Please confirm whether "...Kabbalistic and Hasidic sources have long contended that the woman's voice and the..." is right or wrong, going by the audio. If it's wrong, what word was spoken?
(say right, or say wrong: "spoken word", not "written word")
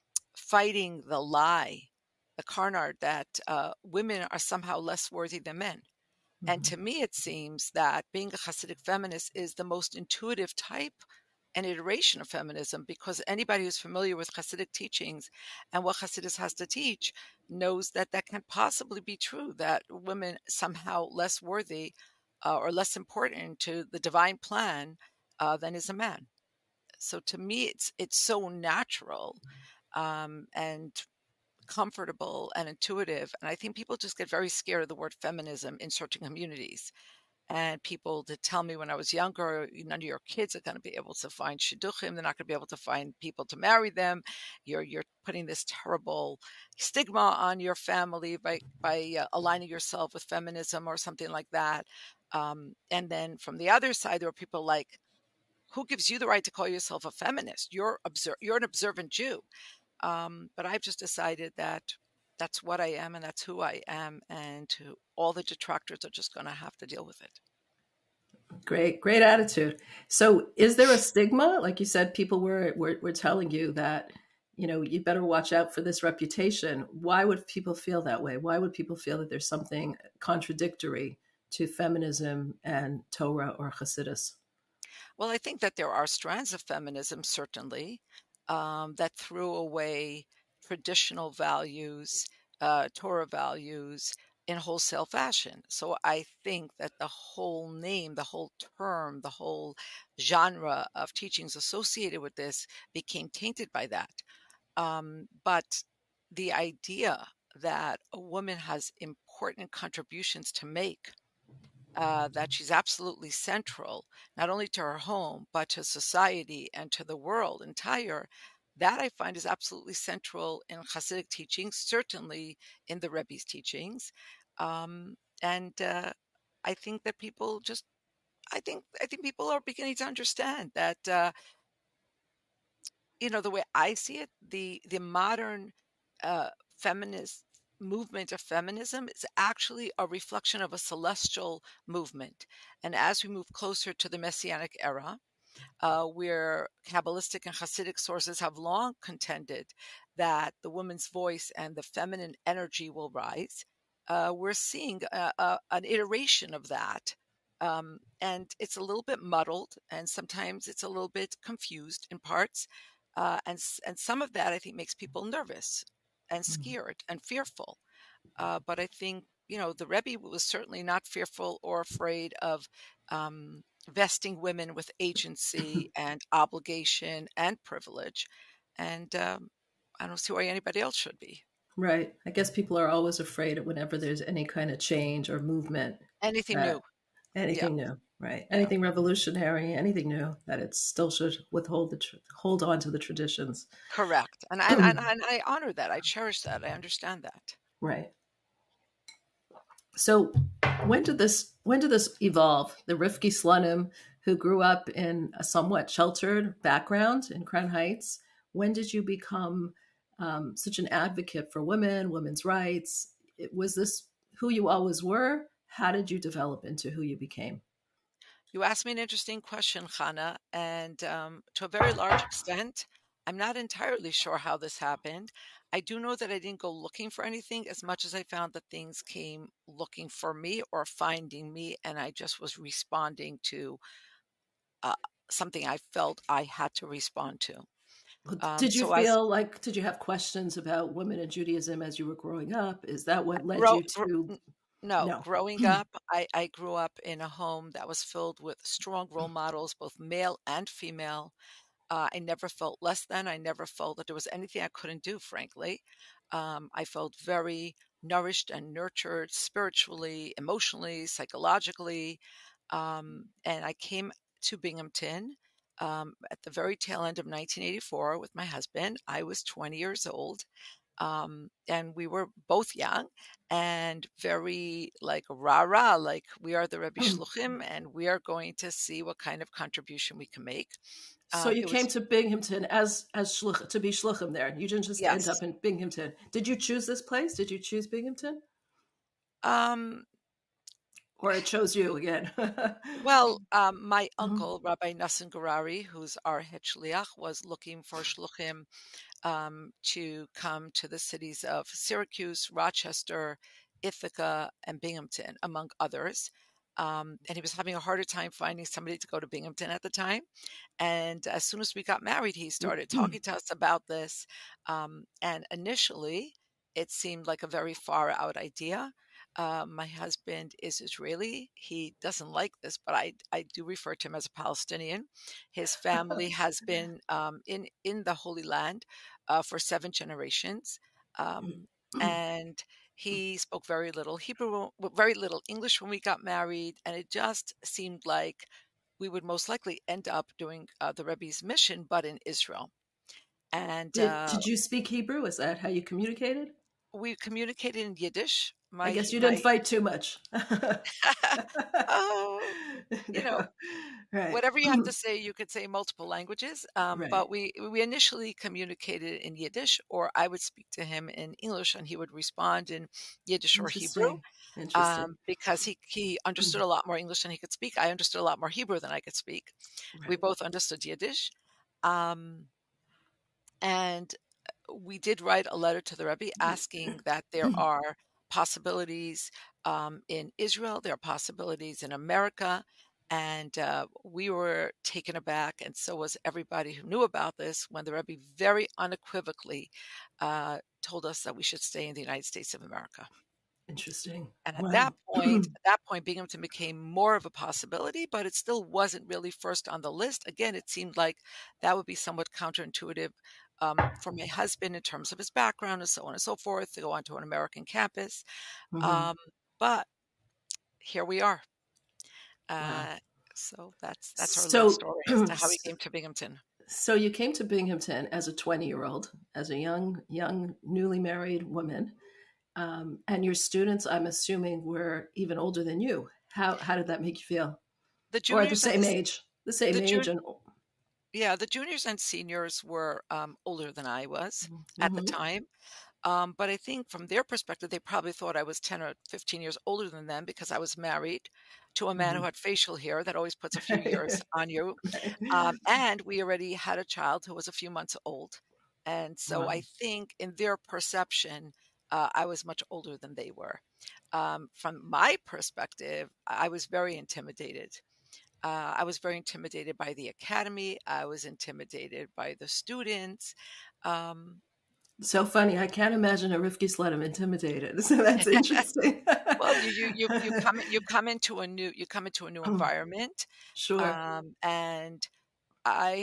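right.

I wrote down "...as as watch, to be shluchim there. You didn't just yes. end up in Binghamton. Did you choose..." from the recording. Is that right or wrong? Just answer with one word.
wrong.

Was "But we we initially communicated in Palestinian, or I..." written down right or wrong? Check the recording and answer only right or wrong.
wrong.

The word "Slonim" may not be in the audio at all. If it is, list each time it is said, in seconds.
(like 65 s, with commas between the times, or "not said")
203 s, 466 s.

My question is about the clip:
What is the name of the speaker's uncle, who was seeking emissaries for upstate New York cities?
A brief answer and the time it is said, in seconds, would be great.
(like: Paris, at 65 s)
Rabbi Nosson Gurary, at 294 s.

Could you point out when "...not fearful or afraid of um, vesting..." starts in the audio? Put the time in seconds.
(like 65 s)
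170 s.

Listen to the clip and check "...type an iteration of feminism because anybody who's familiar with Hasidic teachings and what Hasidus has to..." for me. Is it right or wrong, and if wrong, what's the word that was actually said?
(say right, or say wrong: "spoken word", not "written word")
right.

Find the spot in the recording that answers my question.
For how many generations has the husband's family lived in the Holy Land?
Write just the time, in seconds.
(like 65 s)
329 s.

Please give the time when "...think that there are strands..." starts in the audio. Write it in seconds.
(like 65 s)
85 s.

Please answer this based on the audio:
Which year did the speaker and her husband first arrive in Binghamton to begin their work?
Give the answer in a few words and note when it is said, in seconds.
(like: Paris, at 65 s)
1984, at 267 s.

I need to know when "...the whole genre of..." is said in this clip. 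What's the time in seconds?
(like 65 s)
99 s.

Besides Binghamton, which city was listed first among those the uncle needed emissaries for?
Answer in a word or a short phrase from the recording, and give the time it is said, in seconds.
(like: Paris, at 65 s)
Syracuse, at 301 s.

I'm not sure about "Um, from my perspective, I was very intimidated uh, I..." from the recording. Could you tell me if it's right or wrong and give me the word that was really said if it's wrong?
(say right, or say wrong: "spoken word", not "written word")
right.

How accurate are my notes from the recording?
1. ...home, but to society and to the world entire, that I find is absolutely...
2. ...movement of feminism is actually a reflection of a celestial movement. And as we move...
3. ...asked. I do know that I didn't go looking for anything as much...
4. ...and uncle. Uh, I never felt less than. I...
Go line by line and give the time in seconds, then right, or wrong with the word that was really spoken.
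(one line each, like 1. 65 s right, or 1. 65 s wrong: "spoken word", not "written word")
1. 114 s right
2. 137 s right
3. 224 s wrong: "happened", not "asked"
4. 250 s wrong: "female", not "uncle".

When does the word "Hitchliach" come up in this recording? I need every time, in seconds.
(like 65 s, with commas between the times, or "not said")
296 s.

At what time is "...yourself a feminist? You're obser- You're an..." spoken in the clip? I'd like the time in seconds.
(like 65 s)
56 s.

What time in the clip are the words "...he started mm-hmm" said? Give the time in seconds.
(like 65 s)
312 s.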